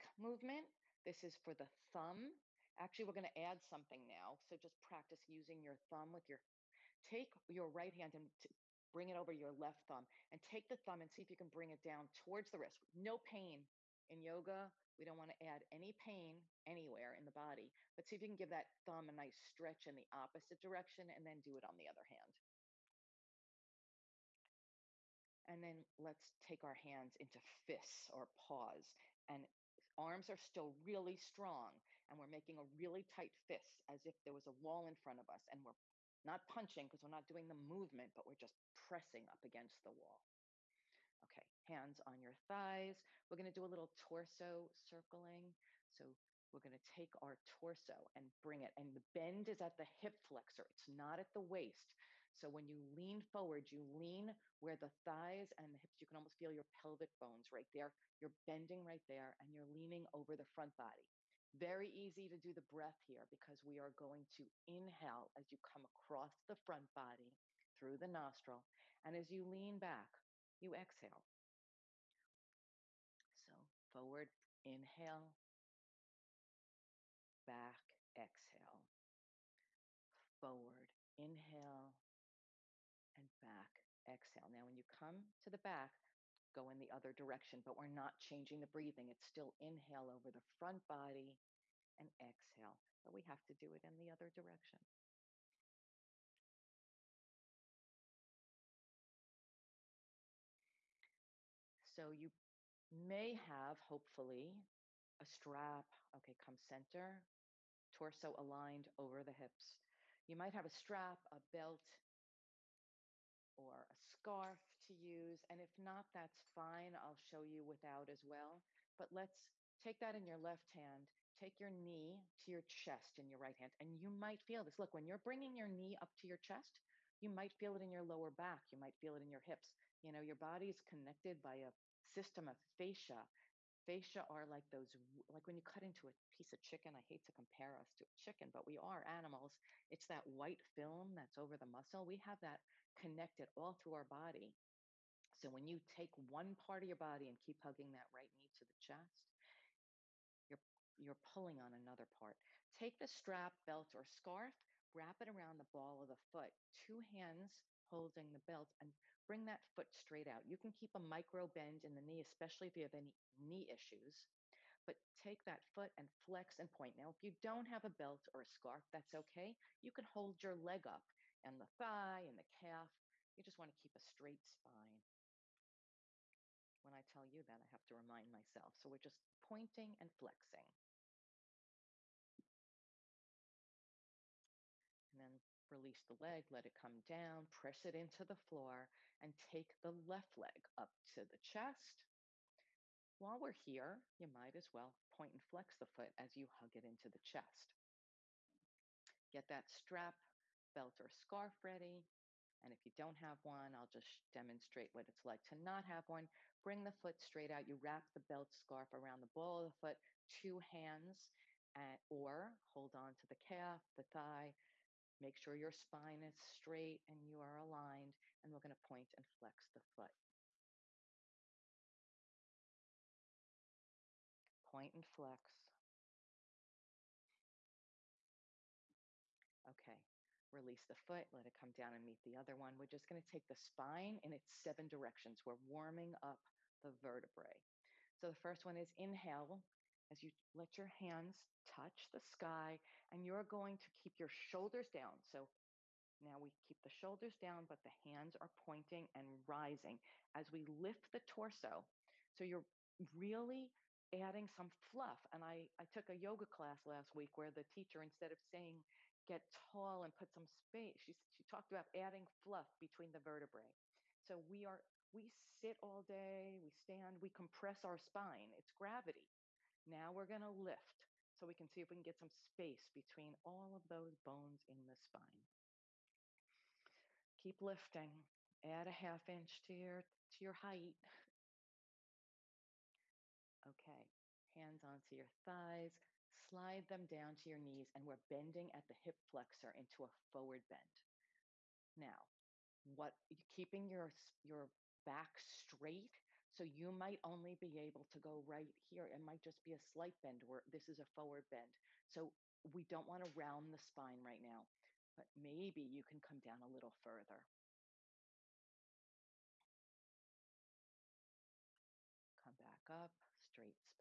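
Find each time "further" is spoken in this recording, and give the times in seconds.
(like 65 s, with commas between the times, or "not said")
307 s.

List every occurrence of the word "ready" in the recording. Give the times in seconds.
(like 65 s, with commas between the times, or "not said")
201 s.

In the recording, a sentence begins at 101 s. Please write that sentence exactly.
So you may have, hopefully, a strap.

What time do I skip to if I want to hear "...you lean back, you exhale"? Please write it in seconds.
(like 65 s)
69 s.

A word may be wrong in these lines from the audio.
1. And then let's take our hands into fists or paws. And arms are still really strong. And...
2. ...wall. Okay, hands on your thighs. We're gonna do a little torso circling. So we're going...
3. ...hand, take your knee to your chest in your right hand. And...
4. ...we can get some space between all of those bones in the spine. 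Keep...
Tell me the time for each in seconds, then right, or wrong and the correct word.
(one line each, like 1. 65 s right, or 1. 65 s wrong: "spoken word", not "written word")
1. 25 s right
2. 39 s right
3. 120 s right
4. 271 s right.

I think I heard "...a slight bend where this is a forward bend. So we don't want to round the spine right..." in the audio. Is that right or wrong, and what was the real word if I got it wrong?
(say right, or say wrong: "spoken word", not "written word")
right.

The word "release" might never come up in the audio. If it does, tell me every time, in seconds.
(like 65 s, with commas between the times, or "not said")
185 s, 230 s.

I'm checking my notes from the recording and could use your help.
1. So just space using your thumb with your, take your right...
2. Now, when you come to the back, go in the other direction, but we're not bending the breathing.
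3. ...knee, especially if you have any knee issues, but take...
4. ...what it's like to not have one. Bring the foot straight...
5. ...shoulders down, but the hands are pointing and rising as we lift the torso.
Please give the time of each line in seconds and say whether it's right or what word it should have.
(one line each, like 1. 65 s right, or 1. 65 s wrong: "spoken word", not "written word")
1. 4 s wrong: "practice", not "space"
2. 84 s wrong: "changing", not "bending"
3. 162 s right
4. 204 s right
5. 246 s right.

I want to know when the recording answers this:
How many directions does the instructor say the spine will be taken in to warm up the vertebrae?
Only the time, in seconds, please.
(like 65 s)
234 s.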